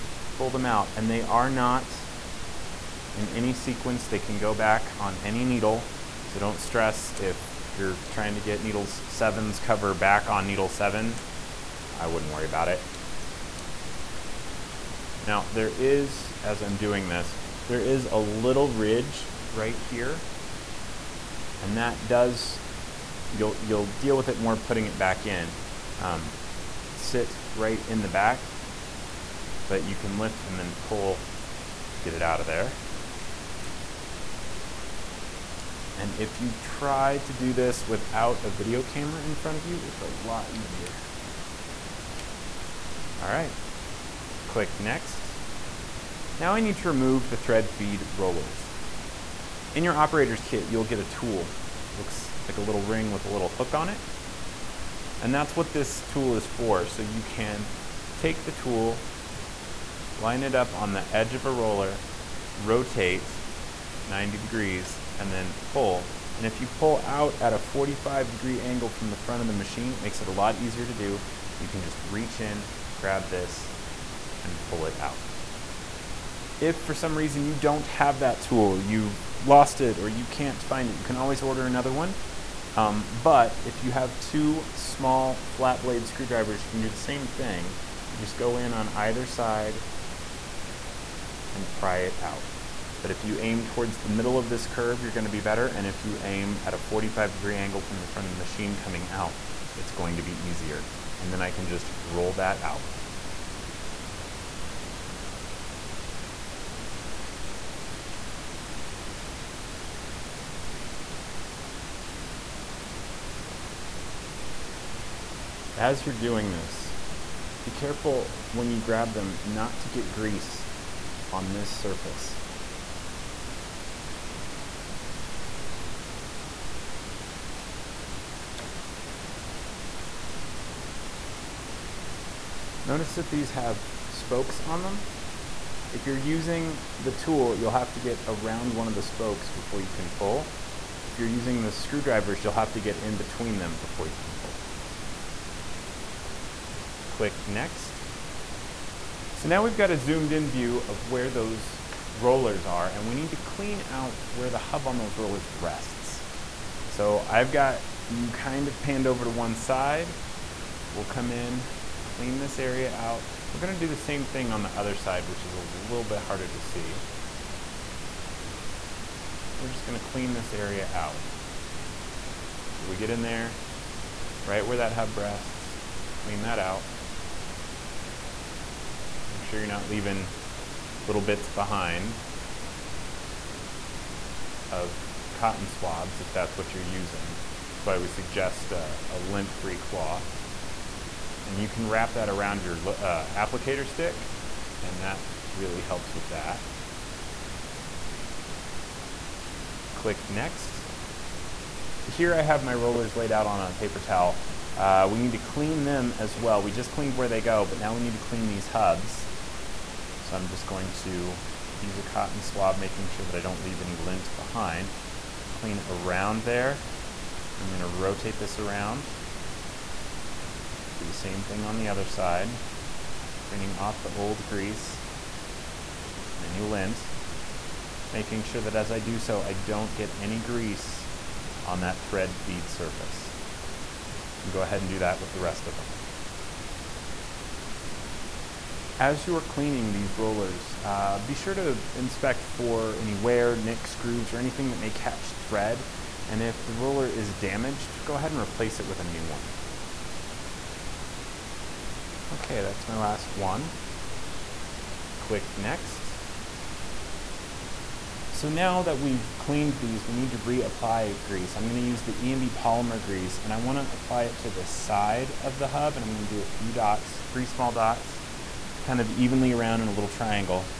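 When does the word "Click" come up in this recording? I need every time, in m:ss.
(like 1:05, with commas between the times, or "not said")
0:44, 2:27, 3:19, 4:15.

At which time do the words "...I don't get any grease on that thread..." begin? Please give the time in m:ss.
3:49.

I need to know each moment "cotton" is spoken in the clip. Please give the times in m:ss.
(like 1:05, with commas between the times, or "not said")
3:05, 3:32.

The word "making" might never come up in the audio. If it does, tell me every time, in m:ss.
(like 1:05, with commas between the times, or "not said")
3:32, 3:48.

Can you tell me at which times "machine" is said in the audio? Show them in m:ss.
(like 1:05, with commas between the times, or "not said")
1:09, 1:38.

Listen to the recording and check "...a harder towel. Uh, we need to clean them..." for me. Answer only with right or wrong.
wrong.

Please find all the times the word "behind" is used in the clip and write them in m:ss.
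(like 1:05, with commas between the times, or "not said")
3:01, 3:34.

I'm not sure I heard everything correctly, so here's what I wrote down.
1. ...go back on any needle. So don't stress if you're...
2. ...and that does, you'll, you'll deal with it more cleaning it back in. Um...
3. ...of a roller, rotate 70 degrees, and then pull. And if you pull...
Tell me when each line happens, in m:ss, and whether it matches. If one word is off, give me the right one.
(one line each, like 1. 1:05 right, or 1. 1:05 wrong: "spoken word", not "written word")
1. 0:04 right
2. 0:21 wrong: "putting", not "cleaning"
3. 1:01 wrong: "90", not "70".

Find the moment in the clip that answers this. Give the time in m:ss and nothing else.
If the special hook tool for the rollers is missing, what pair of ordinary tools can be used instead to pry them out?
1:24.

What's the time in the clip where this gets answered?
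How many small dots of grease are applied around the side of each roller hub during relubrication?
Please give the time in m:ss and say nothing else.
4:27.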